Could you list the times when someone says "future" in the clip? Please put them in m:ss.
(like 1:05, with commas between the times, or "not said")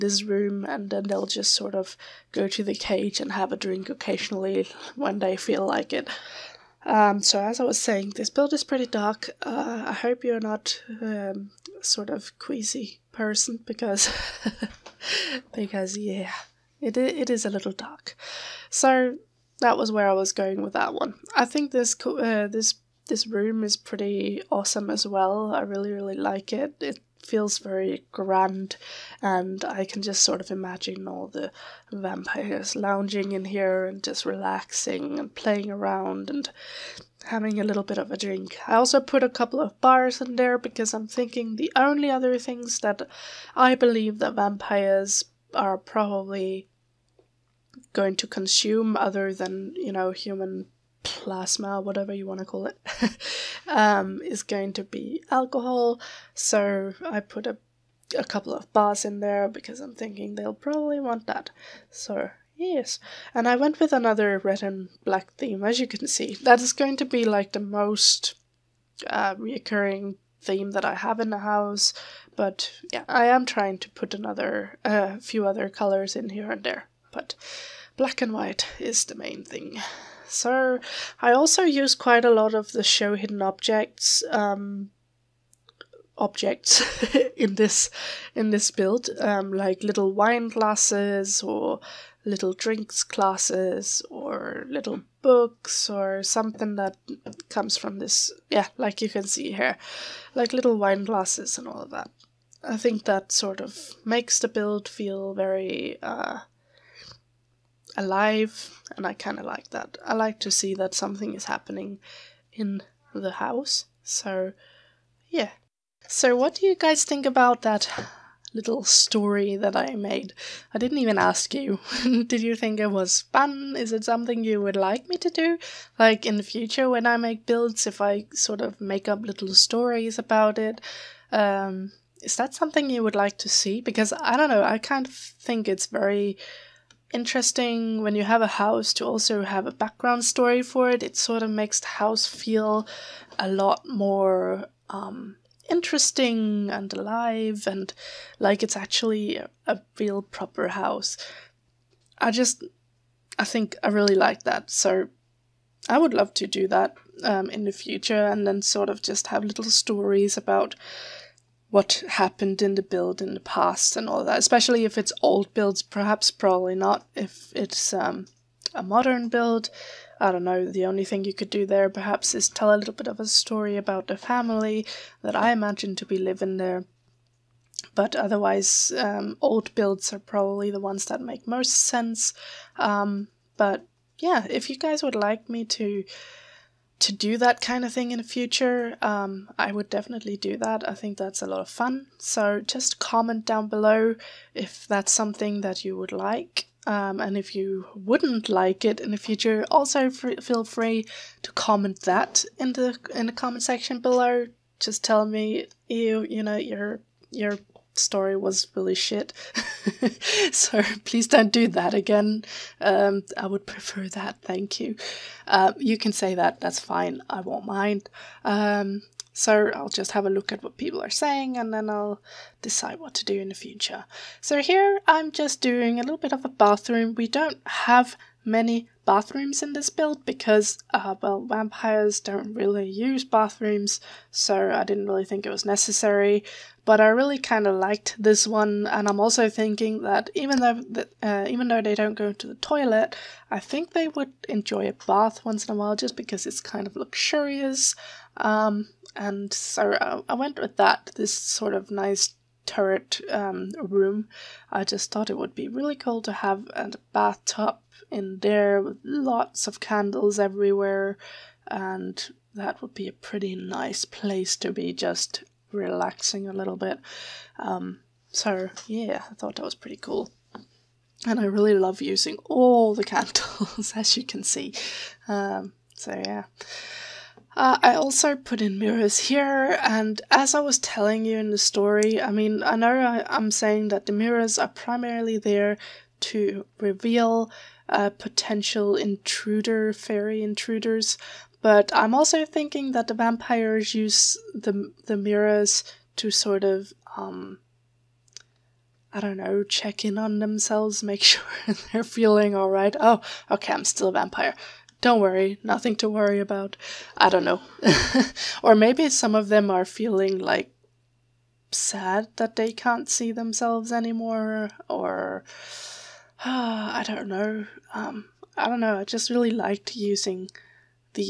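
2:06, 2:37, 3:08, 3:19, 3:43.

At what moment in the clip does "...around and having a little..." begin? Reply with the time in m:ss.
0:35.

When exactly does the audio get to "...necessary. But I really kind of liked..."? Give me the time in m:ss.
3:55.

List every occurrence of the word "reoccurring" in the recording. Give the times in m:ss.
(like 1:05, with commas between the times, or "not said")
1:09.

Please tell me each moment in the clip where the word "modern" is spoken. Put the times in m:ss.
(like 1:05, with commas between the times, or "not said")
2:48.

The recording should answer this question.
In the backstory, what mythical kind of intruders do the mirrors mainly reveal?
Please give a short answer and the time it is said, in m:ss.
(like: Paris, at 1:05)
Fairy intruders, at 4:49.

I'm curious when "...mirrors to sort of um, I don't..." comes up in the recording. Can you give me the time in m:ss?
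4:55.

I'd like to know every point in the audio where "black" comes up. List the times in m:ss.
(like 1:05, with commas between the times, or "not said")
1:05, 1:17.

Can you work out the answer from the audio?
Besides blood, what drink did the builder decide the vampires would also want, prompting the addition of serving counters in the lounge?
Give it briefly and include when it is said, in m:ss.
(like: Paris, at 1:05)
Alcohol, at 0:55.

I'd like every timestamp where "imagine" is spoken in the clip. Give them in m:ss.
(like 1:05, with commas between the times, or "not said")
0:30, 2:55.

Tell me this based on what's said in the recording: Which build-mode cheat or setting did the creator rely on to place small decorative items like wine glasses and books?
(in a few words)
Show hidden objects.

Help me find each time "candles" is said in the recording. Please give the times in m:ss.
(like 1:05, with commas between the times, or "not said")
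4:19, 4:33.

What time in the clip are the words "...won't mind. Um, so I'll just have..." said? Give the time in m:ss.
3:37.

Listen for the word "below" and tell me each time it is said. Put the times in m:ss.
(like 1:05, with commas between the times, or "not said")
3:13, 3:23.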